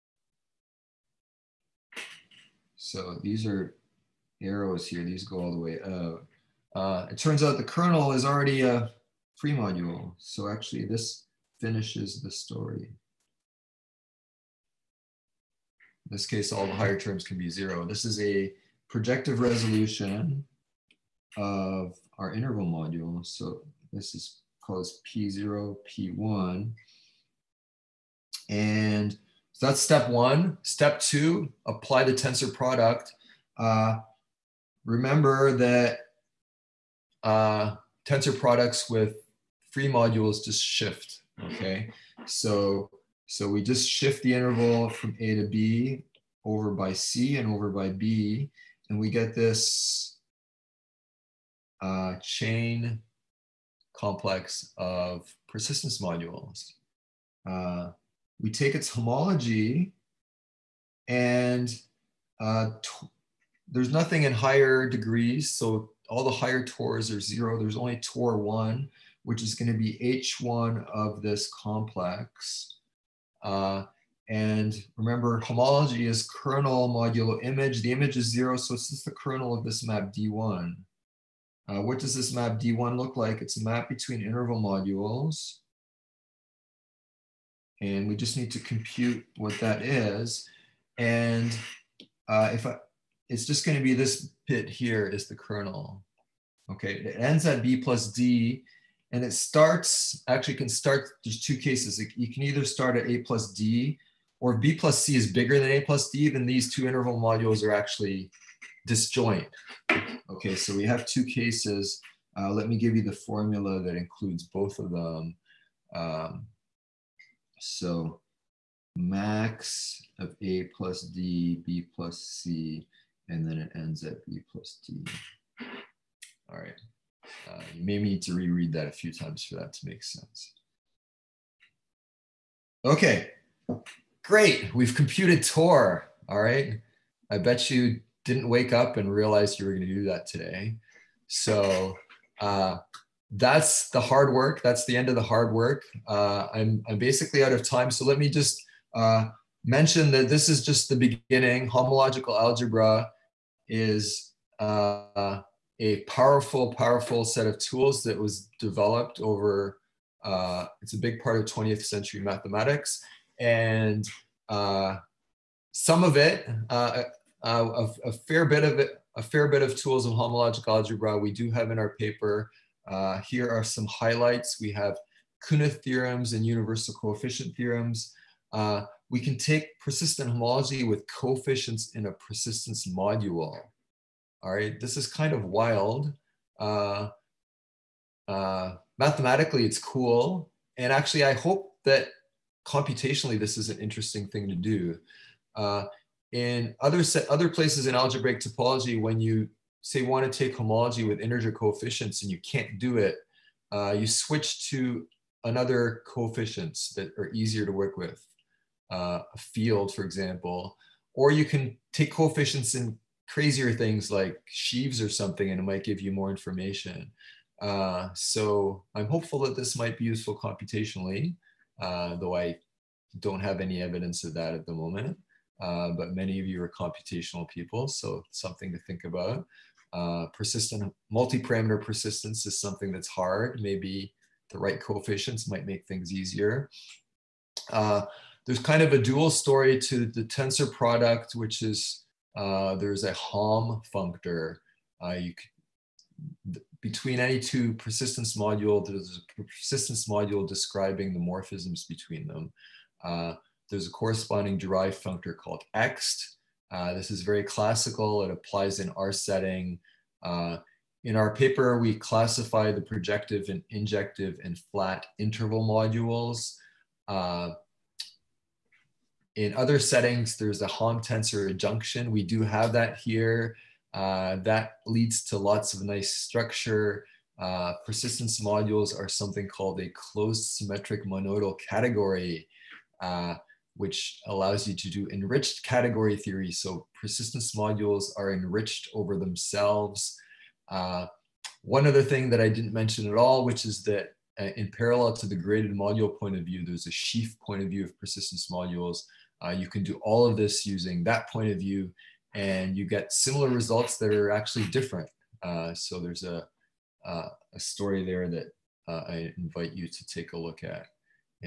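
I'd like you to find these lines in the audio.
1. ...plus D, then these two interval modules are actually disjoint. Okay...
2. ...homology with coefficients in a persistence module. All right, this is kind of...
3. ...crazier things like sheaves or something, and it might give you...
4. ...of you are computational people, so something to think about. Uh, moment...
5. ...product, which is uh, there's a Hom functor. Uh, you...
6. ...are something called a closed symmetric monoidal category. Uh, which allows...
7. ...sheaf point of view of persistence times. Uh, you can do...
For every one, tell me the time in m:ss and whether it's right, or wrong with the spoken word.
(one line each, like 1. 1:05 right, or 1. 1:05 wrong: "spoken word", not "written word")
1. 1:45 right
2. 3:00 right
3. 3:33 right
4. 3:46 wrong: "persistent", not "moment"
5. 4:00 right
6. 4:38 right
7. 4:56 wrong: "modules", not "times".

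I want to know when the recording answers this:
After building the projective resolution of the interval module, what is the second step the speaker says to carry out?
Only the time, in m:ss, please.
0:31.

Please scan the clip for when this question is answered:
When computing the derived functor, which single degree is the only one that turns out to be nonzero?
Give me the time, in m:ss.
1:07.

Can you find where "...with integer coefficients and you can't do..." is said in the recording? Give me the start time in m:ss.
3:21.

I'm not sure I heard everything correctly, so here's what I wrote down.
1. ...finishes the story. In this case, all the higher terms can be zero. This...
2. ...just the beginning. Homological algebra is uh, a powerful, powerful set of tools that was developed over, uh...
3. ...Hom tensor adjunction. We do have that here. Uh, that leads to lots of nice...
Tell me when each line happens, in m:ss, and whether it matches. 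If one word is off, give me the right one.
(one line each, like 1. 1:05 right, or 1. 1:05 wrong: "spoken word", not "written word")
1. 0:11 right
2. 2:30 right
3. 4:30 right.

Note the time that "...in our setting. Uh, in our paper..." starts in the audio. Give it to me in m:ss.
4:18.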